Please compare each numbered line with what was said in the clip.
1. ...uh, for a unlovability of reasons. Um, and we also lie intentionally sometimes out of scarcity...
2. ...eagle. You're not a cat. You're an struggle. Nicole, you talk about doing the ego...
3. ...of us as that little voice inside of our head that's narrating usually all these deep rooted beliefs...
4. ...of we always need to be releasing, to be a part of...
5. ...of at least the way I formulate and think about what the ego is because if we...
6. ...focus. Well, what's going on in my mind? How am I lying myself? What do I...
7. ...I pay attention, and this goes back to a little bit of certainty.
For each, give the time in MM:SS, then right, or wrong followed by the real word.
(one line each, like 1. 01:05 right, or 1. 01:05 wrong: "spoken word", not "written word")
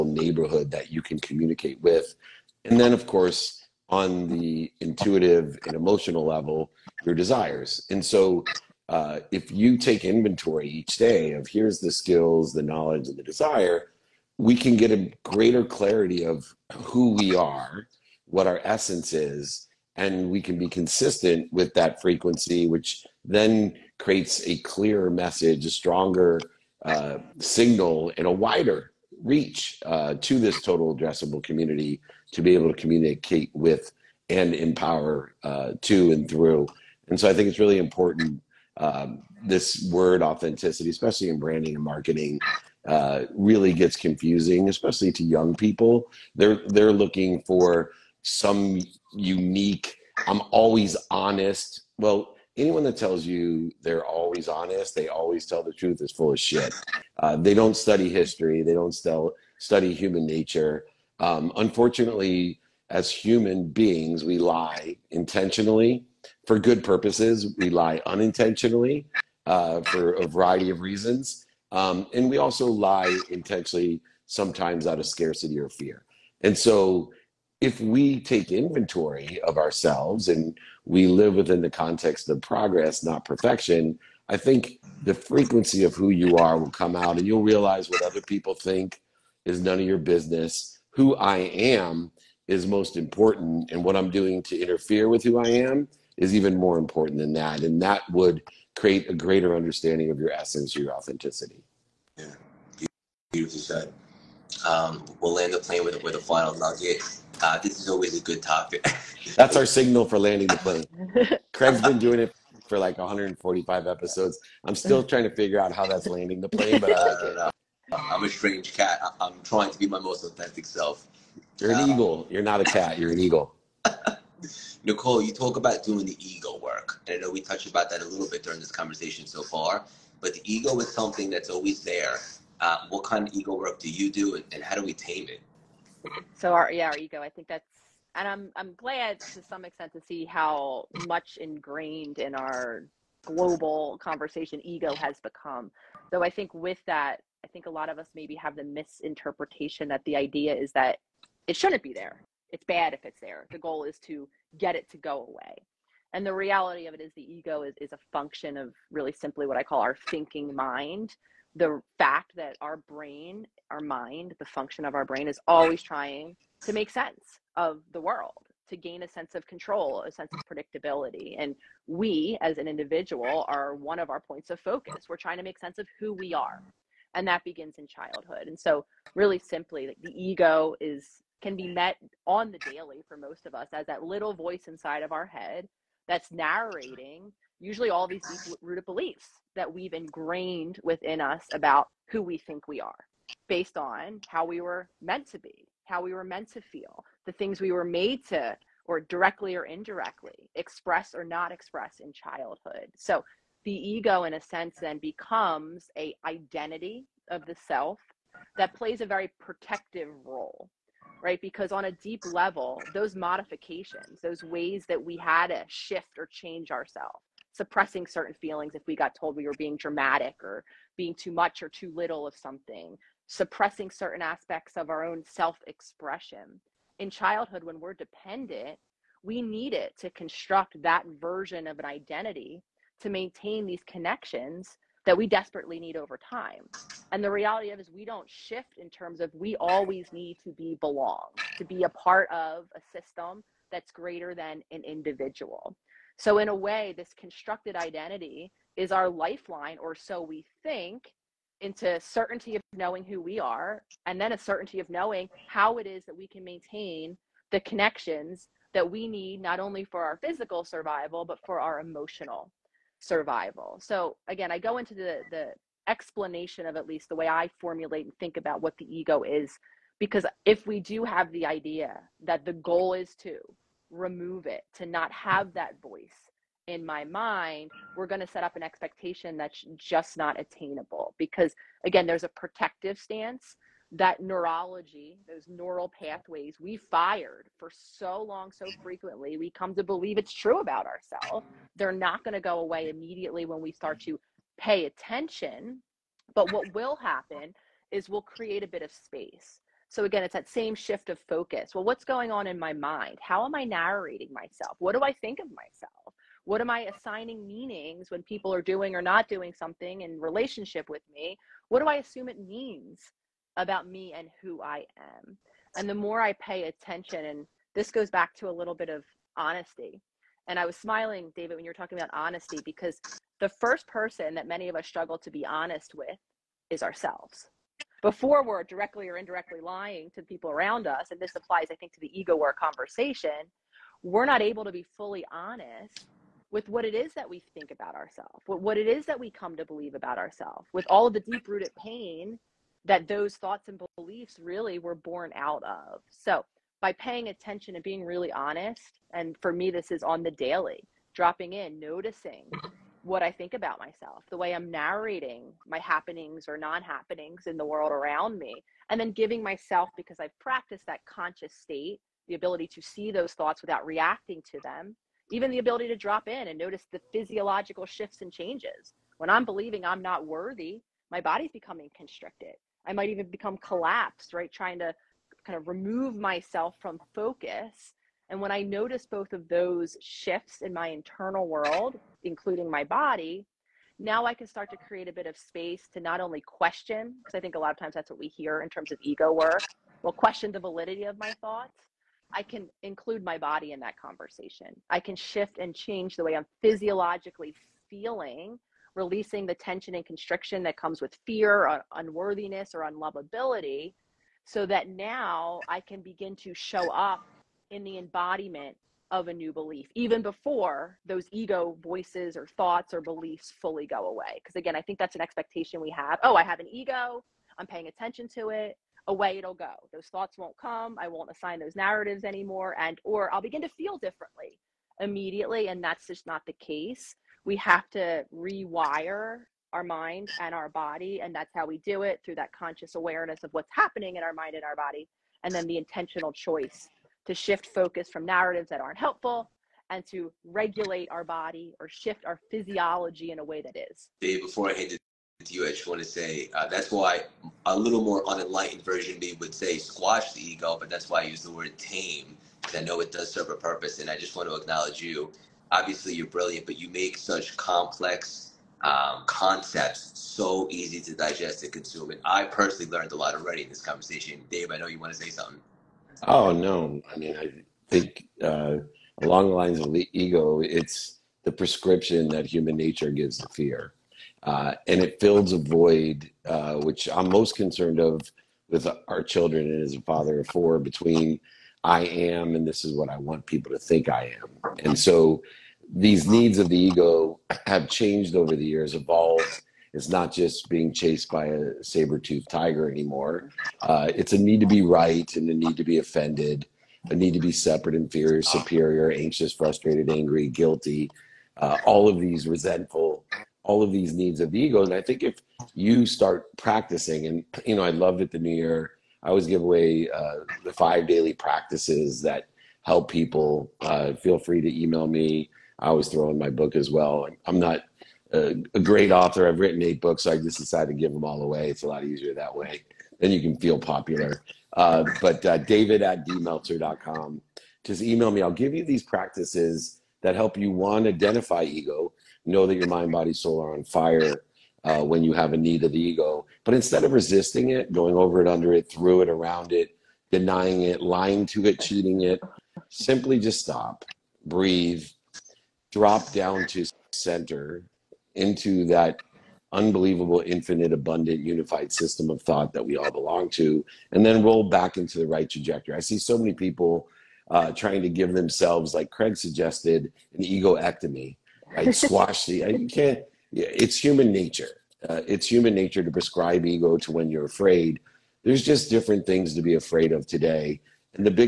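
1. 01:09 wrong: "variety", not "unlovability"
2. 02:01 wrong: "eagle", not "struggle"
3. 03:03 right
4. 03:59 wrong: "belong", not "releasing"
5. 04:26 right
6. 05:01 wrong: "narrating", not "lying"
7. 05:16 wrong: "honesty", not "certainty".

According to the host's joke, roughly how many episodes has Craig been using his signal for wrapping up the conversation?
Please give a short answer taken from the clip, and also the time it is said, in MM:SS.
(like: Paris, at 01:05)
145, at 01:52.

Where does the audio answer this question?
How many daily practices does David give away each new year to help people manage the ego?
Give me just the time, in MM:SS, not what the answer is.
08:30.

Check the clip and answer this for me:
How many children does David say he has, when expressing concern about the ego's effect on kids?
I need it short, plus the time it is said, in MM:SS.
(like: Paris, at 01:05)
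Four, at 08:00.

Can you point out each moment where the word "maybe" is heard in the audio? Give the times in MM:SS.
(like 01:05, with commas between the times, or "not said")
02:28.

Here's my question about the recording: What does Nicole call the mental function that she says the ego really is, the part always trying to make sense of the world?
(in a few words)
Thinking mind.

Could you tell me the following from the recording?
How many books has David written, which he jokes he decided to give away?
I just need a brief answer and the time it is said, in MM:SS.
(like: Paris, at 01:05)
8, at 08:39.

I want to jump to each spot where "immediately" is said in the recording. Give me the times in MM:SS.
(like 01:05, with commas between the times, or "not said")
04:52, 07:04.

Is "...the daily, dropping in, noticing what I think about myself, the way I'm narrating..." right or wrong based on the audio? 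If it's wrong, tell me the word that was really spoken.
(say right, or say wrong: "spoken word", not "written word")
right.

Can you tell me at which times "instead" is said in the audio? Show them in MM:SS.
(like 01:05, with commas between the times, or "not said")
08:56.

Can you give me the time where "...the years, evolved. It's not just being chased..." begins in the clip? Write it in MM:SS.
08:08.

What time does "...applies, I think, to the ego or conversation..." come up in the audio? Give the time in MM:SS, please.
05:31.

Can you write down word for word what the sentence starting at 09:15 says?
I see so many people uh, trying to give themselves, like Craig suggested, an egoectomy.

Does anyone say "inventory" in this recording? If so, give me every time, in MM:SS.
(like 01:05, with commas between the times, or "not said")
00:10, 01:18.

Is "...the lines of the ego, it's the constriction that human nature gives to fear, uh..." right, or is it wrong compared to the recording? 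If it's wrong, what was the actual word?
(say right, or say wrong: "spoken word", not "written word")
wrong: "prescription", not "constriction".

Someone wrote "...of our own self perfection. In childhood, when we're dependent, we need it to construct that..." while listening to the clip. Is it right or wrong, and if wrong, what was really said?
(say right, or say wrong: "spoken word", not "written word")
wrong: "expression", not "perfection".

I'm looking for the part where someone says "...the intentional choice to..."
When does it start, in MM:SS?
07:15.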